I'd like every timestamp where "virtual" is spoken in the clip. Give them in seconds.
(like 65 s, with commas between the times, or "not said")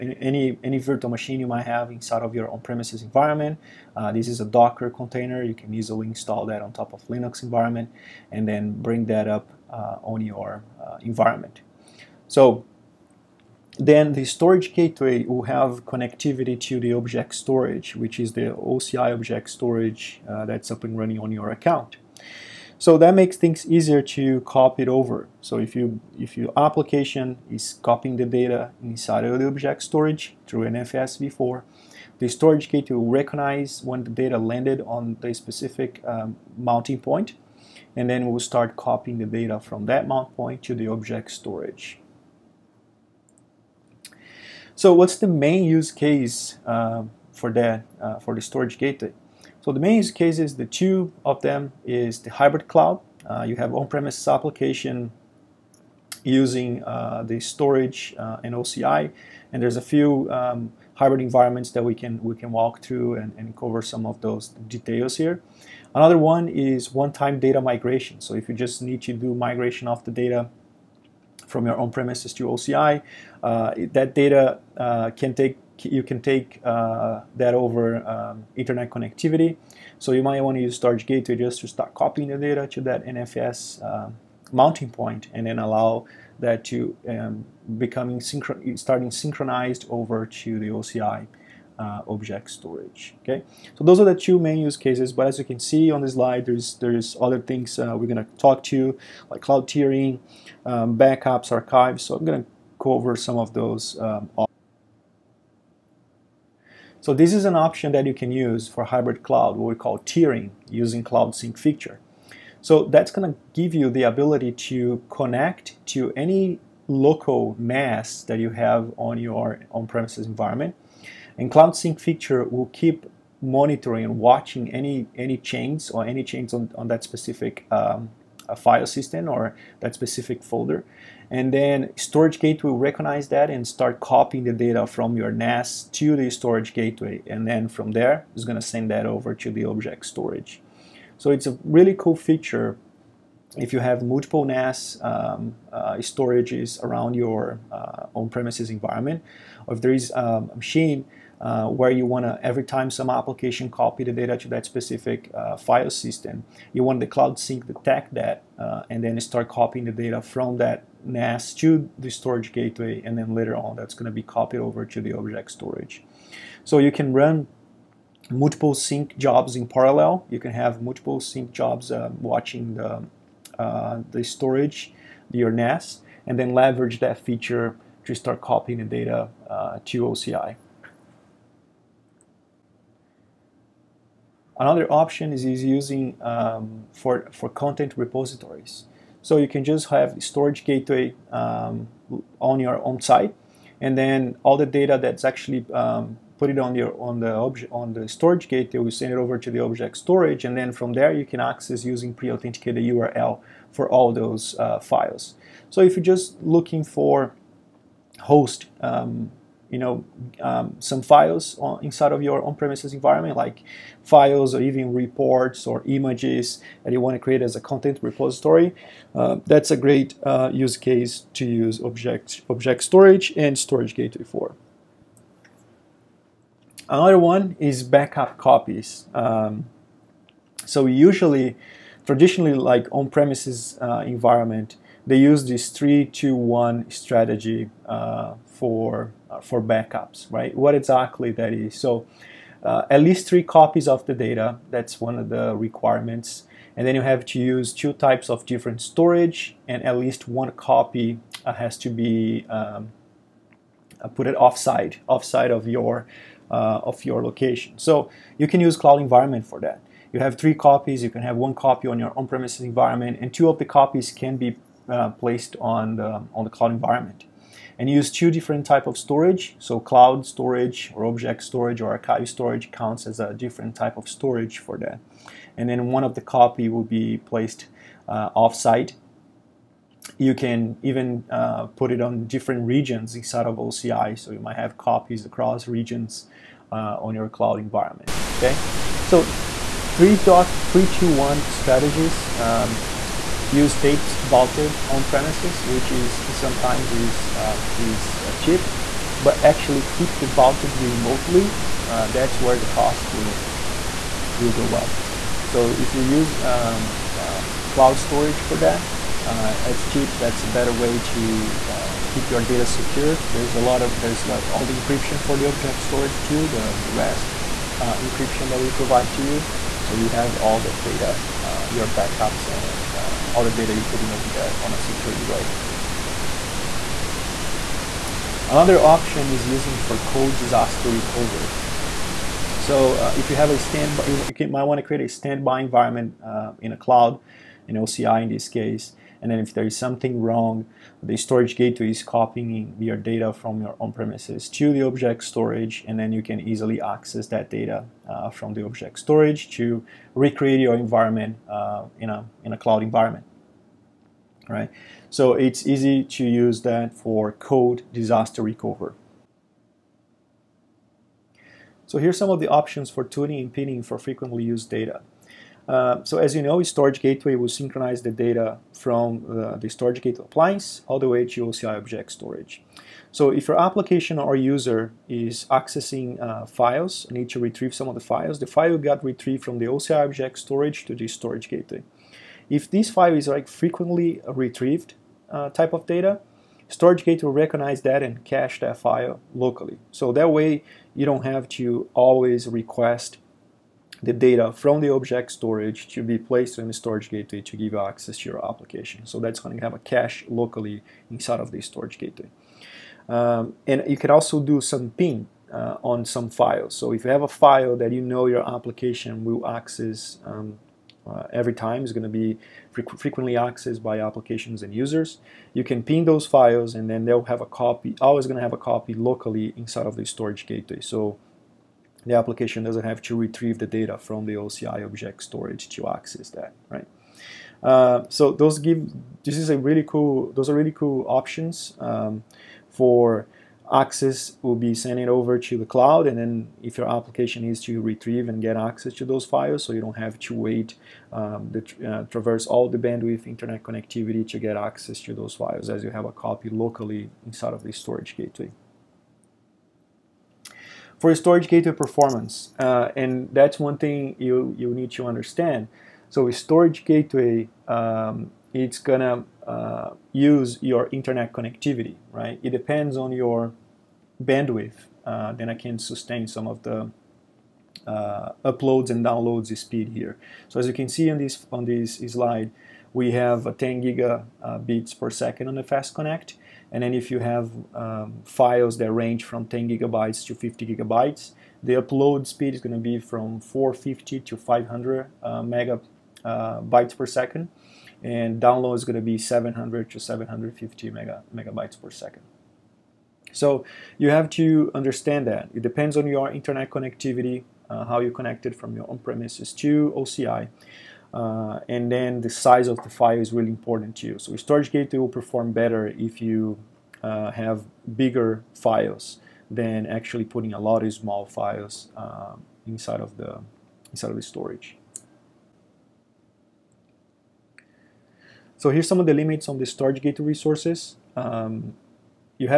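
0 s.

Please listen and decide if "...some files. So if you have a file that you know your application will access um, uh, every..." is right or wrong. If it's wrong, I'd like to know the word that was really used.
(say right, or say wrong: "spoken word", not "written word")
right.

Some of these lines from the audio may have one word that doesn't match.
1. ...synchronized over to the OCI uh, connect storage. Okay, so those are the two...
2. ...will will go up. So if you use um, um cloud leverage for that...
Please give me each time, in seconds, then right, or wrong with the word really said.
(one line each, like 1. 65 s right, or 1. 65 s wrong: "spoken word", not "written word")
1. 89 s wrong: "object", not "connect"
2. 303 s wrong: "storage", not "leverage".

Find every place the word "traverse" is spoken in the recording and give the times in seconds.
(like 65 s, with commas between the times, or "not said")
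442 s.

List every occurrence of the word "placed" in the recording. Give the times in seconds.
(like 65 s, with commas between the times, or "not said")
265 s, 277 s, 396 s.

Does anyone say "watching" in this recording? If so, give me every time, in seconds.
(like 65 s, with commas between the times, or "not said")
124 s, 172 s.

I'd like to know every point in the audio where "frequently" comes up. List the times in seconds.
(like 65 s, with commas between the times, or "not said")
363 s, 383 s, 412 s.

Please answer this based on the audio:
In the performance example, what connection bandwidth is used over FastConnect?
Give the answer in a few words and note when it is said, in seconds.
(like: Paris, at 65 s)
10 gigabits per second, at 473 s.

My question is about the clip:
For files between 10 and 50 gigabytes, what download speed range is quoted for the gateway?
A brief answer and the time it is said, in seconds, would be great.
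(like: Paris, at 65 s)
700 to 750 MB/s, at 489 s.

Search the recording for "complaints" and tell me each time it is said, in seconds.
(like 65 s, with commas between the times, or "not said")
not said.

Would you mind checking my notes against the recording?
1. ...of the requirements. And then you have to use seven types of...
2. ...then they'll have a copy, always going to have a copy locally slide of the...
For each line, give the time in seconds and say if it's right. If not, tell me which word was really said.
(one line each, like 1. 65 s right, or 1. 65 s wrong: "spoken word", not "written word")
1. 245 s wrong: "two", not "seven"
2. 416 s wrong: "inside", not "slide".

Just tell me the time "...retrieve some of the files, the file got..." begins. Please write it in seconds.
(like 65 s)
377 s.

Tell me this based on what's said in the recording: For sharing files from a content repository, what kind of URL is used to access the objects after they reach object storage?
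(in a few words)
Pre-authenticated URL.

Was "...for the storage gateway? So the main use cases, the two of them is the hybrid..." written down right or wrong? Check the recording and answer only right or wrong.
right.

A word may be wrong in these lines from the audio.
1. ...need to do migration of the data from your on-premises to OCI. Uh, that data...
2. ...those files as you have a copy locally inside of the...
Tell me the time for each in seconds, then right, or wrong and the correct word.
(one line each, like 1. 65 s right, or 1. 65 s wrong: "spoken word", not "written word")
1. 68 s right
2. 445 s right.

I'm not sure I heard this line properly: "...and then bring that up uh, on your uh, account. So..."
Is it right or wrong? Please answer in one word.
wrong.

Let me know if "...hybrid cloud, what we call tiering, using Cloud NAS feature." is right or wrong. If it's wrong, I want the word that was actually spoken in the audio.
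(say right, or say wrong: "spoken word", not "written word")
wrong: "Sync", not "NAS".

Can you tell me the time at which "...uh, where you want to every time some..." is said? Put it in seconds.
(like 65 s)
151 s.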